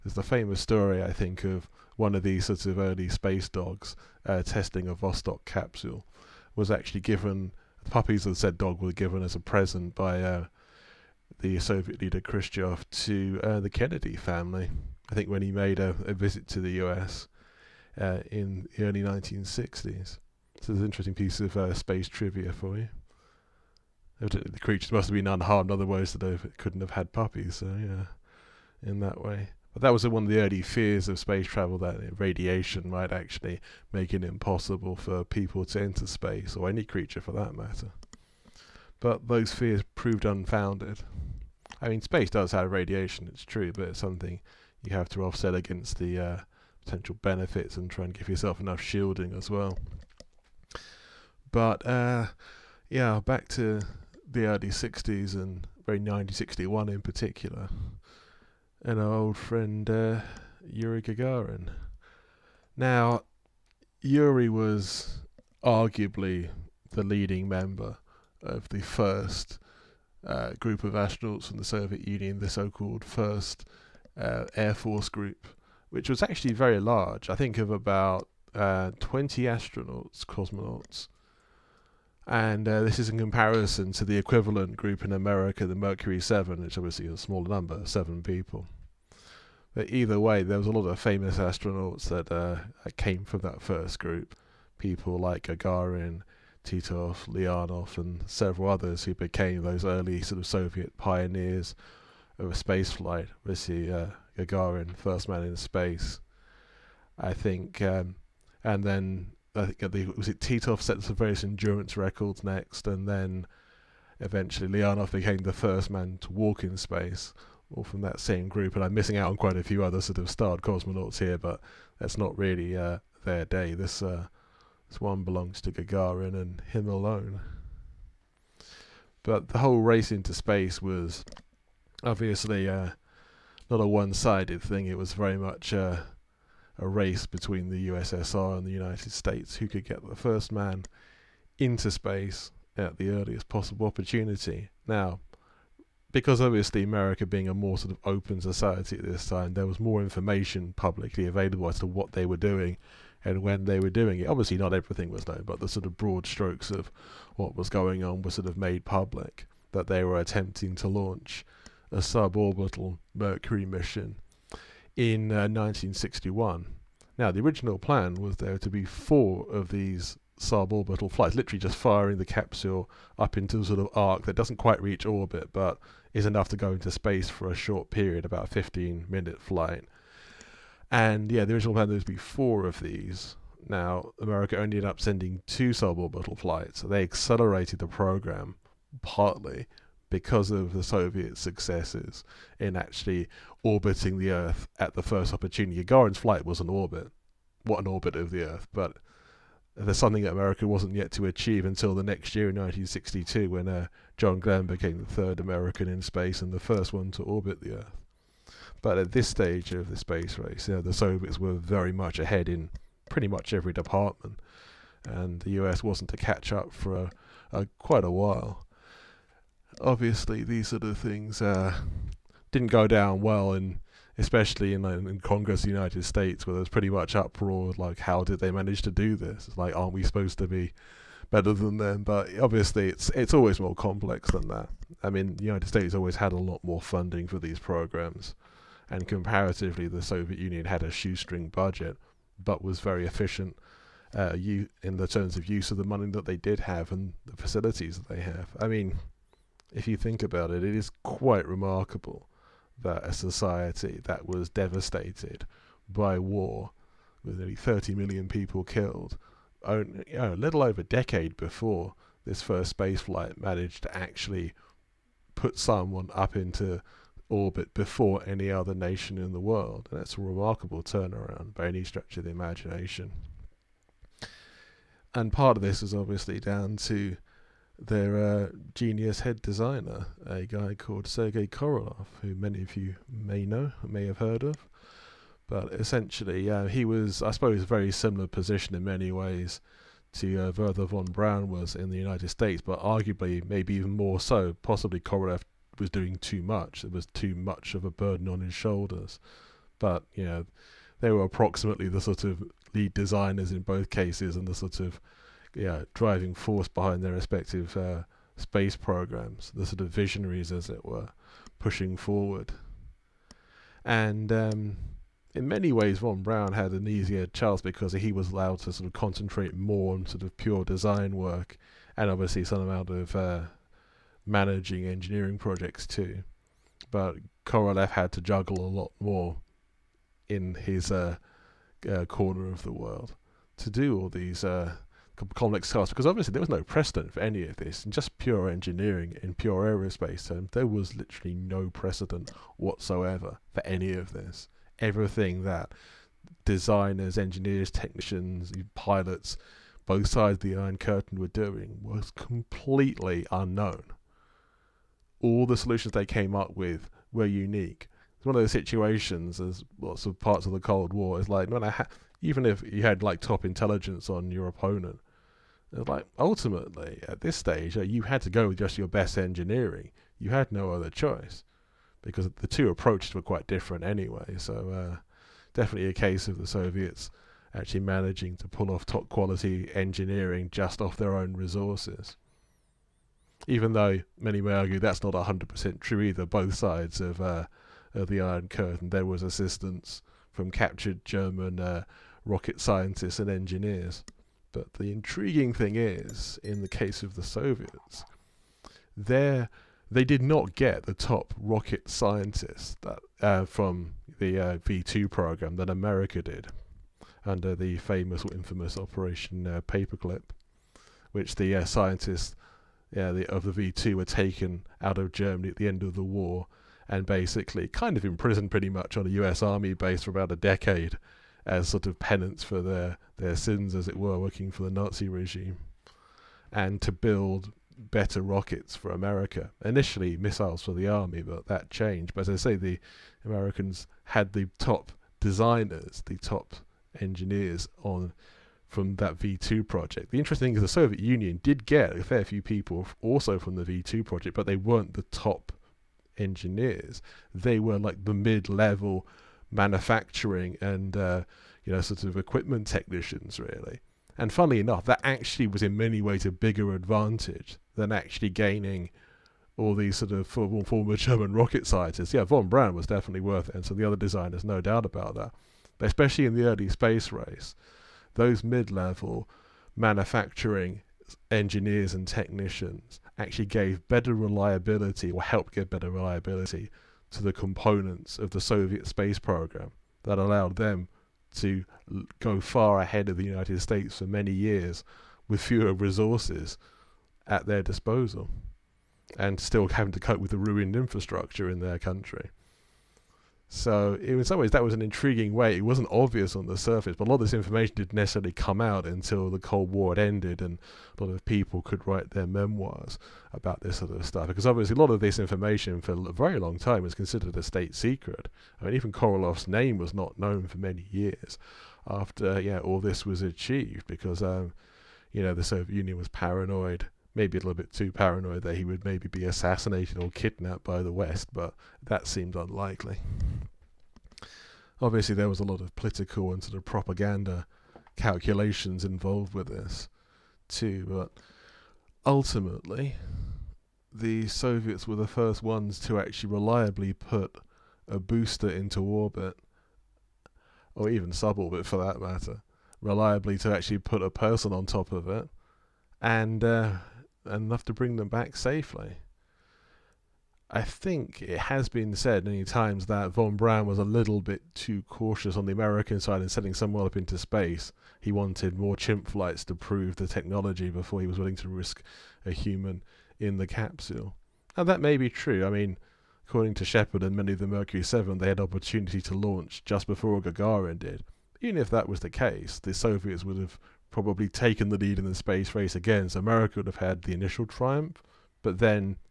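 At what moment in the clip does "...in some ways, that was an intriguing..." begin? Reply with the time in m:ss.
8:13.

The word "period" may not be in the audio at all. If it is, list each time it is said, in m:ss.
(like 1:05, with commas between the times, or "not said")
2:57.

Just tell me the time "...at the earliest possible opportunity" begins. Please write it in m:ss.
2:22.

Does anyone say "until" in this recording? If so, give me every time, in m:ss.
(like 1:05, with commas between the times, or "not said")
3:21, 8:18.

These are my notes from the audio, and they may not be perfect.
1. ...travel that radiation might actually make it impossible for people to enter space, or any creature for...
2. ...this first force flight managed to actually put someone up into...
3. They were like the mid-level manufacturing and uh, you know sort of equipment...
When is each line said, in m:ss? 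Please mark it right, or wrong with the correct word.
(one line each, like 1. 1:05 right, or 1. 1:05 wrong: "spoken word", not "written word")
1. 0:31 right
2. 4:22 wrong: "space", not "force"
3. 7:27 right.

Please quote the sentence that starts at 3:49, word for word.
It's like, aren't we supposed to be better than them?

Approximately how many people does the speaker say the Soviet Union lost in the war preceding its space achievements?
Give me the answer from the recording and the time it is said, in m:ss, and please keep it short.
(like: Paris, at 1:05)
30 million, at 4:17.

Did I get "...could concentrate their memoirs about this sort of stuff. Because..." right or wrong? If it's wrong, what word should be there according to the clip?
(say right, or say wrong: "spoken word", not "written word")
wrong: "write", not "concentrate".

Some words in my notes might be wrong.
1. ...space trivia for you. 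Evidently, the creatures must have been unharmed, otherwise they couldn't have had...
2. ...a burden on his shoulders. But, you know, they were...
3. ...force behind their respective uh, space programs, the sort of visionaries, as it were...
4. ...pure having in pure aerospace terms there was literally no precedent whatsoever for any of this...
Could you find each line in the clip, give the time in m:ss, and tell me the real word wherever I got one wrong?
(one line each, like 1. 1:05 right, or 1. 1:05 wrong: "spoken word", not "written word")
1. 0:21 right
2. 4:57 right
3. 5:06 right
4. 5:38 wrong: "engineering", not "having".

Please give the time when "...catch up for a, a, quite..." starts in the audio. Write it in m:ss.
3:36.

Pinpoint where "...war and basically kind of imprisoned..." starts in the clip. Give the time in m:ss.
6:56.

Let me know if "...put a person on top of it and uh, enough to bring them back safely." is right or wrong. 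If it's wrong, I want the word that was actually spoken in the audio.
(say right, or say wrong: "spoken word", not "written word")
right.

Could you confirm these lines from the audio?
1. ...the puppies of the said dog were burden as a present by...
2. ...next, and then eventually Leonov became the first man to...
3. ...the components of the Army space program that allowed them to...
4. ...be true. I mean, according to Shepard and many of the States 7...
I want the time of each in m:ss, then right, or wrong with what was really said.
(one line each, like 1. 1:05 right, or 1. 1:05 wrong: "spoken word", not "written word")
1. 0:07 wrong: "given", not "burden"
2. 1:52 right
3. 7:57 wrong: "Soviet", not "Army"
4. 9:24 wrong: "Mercury", not "States".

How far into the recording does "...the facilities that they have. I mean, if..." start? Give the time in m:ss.
4:07.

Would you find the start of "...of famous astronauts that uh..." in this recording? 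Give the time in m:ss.
1:30.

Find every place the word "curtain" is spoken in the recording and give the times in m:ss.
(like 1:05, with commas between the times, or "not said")
5:50, 6:28.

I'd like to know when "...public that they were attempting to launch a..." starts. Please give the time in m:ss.
2:38.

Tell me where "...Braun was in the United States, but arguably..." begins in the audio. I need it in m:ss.
4:51.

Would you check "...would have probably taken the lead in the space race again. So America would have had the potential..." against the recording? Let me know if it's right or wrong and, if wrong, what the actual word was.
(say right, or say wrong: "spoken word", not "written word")
wrong: "initial", not "potential".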